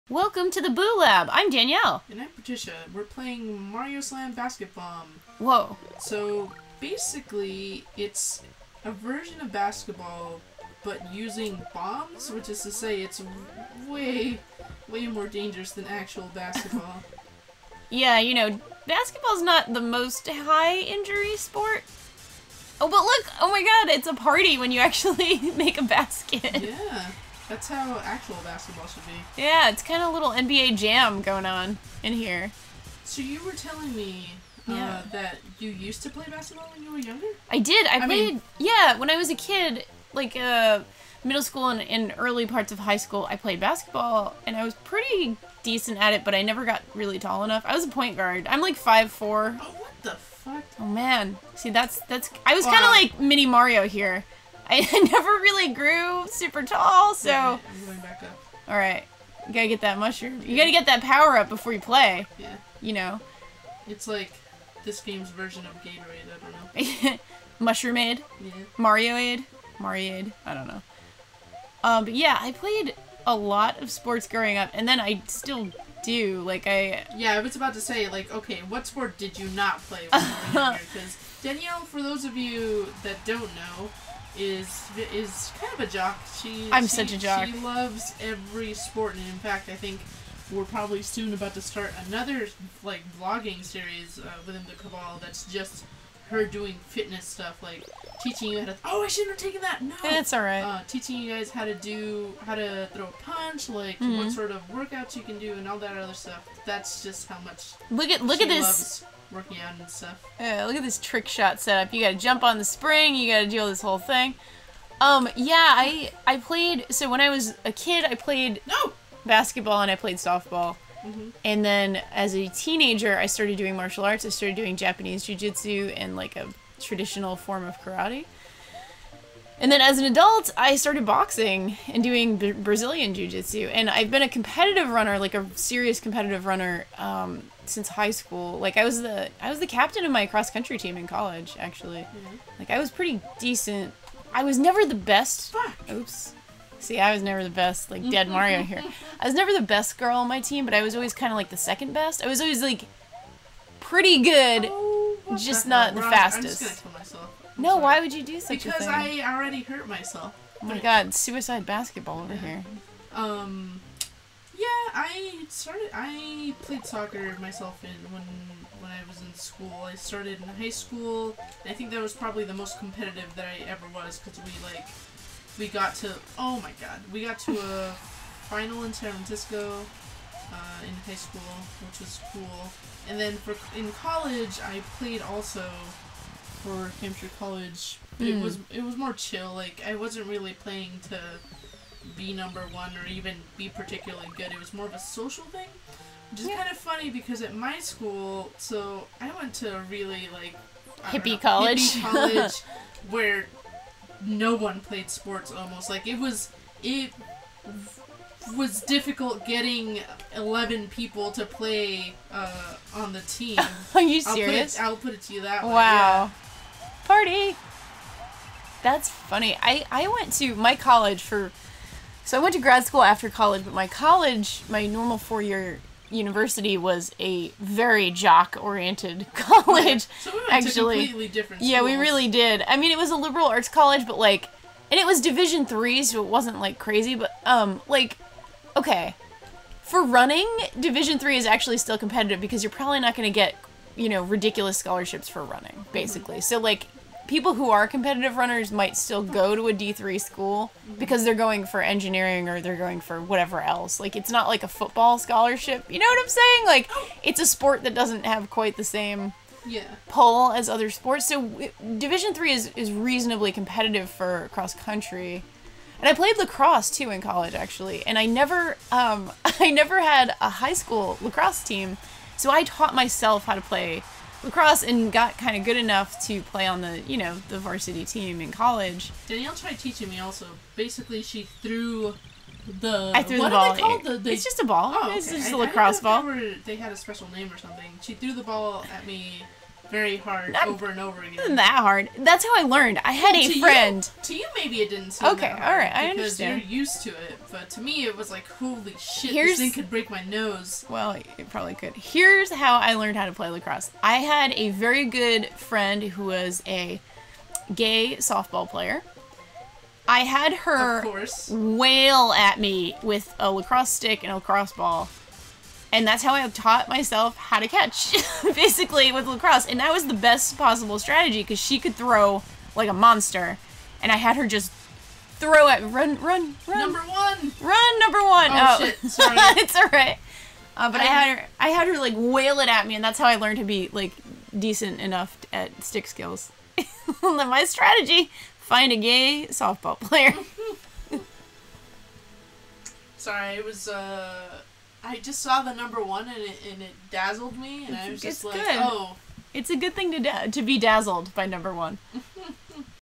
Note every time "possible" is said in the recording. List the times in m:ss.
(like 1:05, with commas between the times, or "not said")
5:20.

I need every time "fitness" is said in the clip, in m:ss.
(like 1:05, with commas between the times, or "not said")
1:36.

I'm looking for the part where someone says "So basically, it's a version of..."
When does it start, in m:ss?
0:06.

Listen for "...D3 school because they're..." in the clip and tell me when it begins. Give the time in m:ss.
4:09.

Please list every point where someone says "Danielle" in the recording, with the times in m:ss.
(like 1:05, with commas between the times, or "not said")
0:01, 1:21, 4:39.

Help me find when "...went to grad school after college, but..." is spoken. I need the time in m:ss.
3:42.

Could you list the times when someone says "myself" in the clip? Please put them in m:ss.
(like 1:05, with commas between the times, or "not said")
2:39, 2:47, 4:32, 5:16.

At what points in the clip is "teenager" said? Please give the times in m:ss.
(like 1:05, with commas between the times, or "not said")
2:02.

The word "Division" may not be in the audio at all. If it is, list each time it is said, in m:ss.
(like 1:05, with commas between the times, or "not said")
3:55, 4:00, 4:21.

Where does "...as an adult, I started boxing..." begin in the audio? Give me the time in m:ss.
2:09.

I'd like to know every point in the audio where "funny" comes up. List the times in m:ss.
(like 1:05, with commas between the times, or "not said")
3:16, 3:39.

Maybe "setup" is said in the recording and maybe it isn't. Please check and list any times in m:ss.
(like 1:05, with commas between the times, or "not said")
1:51.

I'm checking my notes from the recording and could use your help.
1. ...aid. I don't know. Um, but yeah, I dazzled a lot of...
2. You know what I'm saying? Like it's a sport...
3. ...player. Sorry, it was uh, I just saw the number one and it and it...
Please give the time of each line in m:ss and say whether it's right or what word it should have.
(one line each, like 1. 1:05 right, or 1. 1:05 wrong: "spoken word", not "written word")
1. 1:10 wrong: "played", not "dazzled"
2. 4:15 right
3. 5:39 right.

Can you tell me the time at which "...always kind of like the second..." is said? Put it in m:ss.
2:30.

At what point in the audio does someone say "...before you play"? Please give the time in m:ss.
1:01.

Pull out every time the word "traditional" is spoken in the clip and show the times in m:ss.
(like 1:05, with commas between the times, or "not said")
2:06.